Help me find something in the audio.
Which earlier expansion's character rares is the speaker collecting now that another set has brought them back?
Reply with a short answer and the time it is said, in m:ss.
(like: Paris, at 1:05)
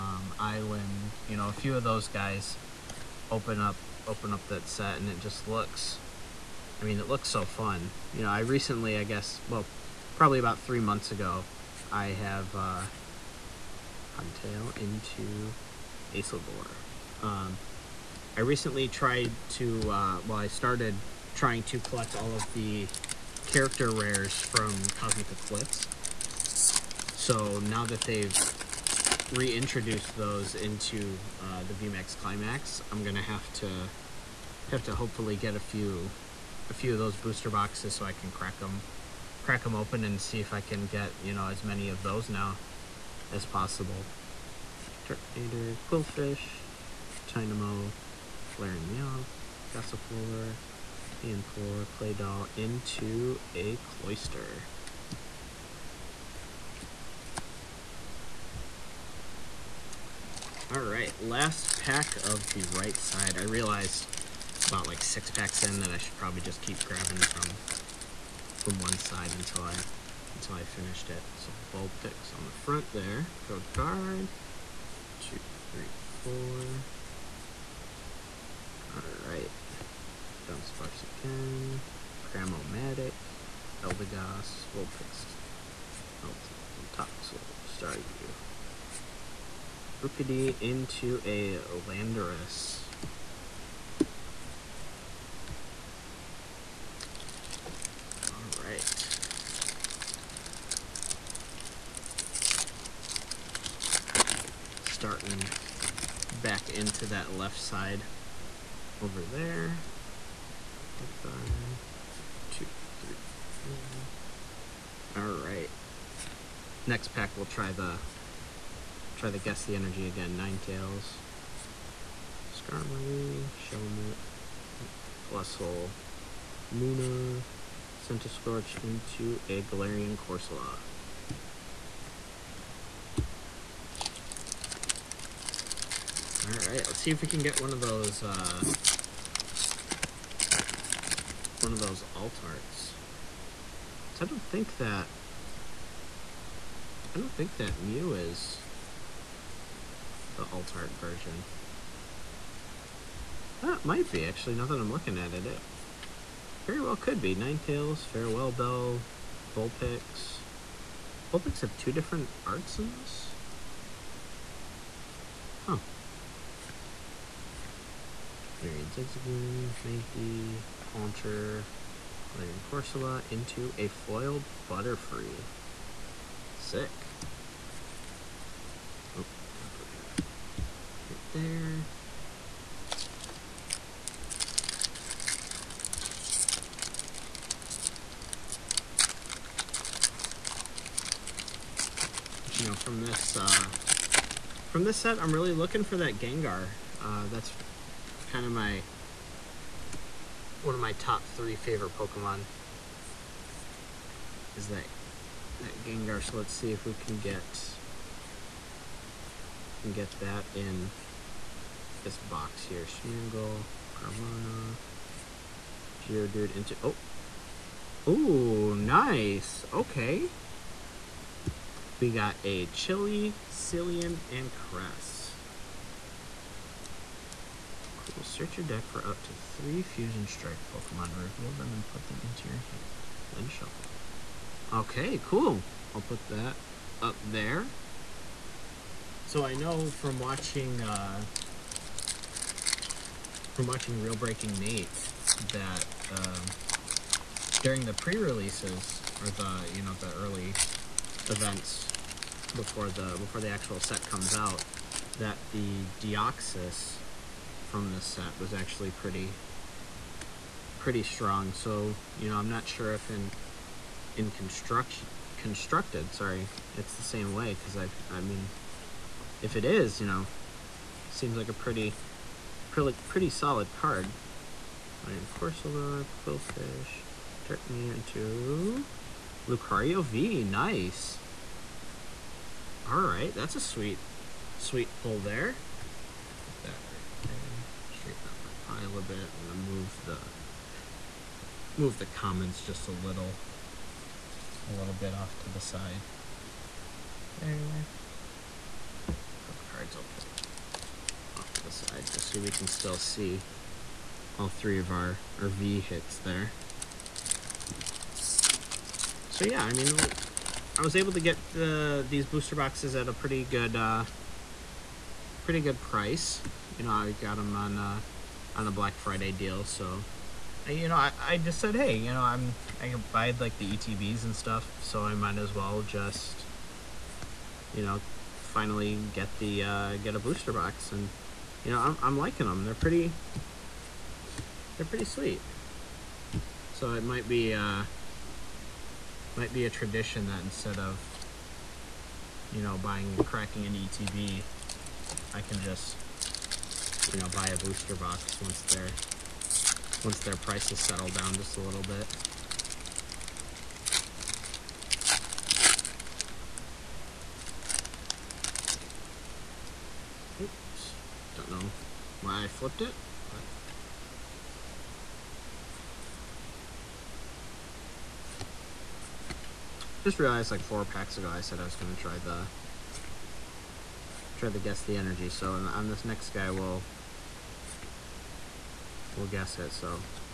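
Cosmic Eclipse, at 0:24.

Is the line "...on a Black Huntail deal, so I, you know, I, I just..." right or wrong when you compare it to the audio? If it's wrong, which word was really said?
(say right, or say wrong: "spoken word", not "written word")
wrong: "Friday", not "Huntail".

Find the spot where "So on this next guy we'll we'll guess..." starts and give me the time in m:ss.
6:15.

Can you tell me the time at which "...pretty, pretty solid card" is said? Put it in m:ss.
4:32.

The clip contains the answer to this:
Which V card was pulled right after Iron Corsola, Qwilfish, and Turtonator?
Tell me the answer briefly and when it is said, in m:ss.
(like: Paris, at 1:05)
Lucario V, at 4:39.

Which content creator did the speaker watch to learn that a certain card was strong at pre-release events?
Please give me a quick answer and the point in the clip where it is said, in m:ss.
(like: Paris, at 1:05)
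Real Breaking Nate, at 4:03.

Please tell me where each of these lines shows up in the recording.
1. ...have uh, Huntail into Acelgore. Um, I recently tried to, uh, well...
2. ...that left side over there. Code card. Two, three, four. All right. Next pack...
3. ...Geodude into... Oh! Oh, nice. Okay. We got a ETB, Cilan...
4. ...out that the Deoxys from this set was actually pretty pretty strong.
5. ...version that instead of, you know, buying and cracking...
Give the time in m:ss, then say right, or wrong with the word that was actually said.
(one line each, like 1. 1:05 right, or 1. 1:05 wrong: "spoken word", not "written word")
1. 0:12 right
2. 1:47 right
3. 3:36 wrong: "Chili", not "ETB"
4. 4:14 right
5. 5:39 wrong: "tradition", not "version".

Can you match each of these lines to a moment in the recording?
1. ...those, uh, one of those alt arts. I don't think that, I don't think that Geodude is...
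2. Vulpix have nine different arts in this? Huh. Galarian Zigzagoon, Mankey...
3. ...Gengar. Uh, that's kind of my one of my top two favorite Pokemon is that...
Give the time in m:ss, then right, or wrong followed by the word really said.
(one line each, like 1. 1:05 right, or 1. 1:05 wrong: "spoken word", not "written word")
1. 2:17 wrong: "Mew", not "Geodude"
2. 2:41 wrong: "two", not "nine"
3. 3:16 wrong: "three", not "two".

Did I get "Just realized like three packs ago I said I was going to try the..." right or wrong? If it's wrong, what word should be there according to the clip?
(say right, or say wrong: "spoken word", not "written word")
wrong: "four", not "three".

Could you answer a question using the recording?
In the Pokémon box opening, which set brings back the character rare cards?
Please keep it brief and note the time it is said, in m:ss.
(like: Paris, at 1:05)
VMAX Climax, at 0:31.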